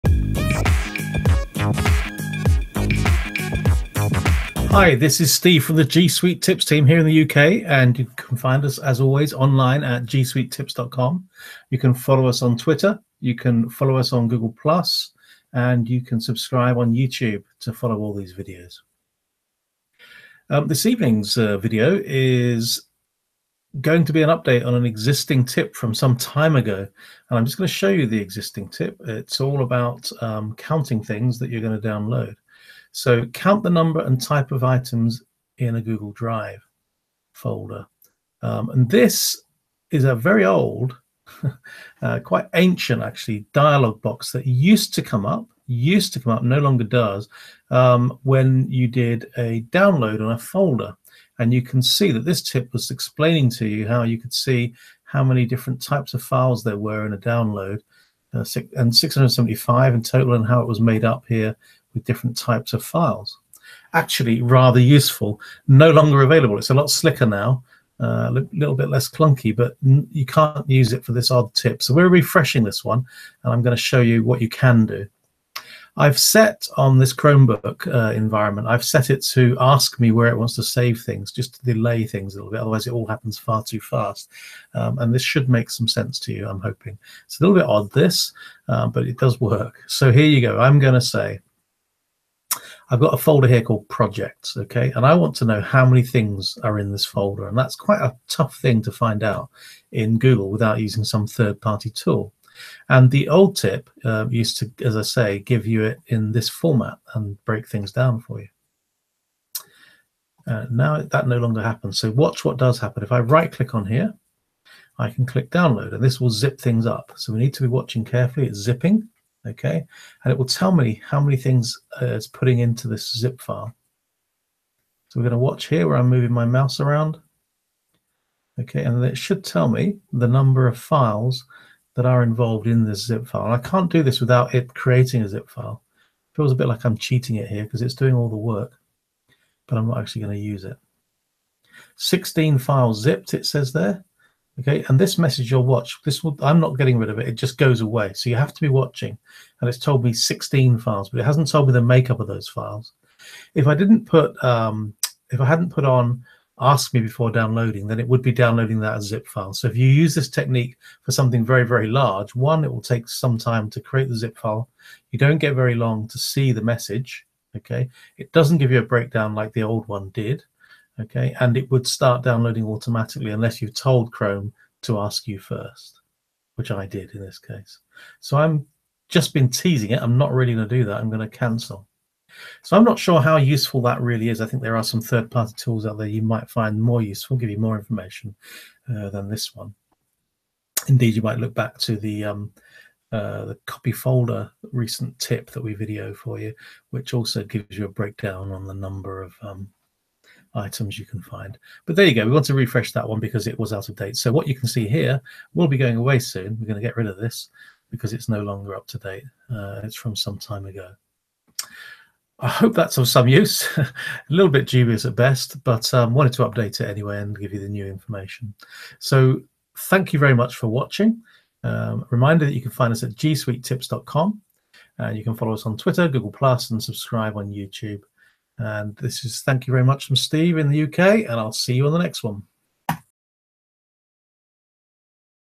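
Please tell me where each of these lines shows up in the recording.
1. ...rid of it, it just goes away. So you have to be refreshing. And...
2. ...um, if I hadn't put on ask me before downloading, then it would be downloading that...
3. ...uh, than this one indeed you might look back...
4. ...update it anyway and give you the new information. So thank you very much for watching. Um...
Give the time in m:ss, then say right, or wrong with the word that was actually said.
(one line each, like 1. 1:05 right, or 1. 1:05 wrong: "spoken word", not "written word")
1. 2:26 wrong: "watching", not "refreshing"
2. 2:34 right
3. 3:08 right
4. 3:36 right.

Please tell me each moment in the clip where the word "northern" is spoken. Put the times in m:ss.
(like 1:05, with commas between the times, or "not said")
not said.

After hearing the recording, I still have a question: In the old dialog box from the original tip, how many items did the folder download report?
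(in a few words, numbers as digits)
675.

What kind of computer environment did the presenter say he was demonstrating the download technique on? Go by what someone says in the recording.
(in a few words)
Chromebook.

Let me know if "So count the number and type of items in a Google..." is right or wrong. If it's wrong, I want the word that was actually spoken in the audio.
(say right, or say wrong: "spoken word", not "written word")
right.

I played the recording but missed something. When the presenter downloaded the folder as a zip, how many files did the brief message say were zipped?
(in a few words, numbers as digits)
16.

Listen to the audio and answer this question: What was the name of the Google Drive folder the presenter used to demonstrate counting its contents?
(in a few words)
projects.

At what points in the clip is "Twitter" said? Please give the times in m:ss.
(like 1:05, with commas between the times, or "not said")
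0:12, 3:45.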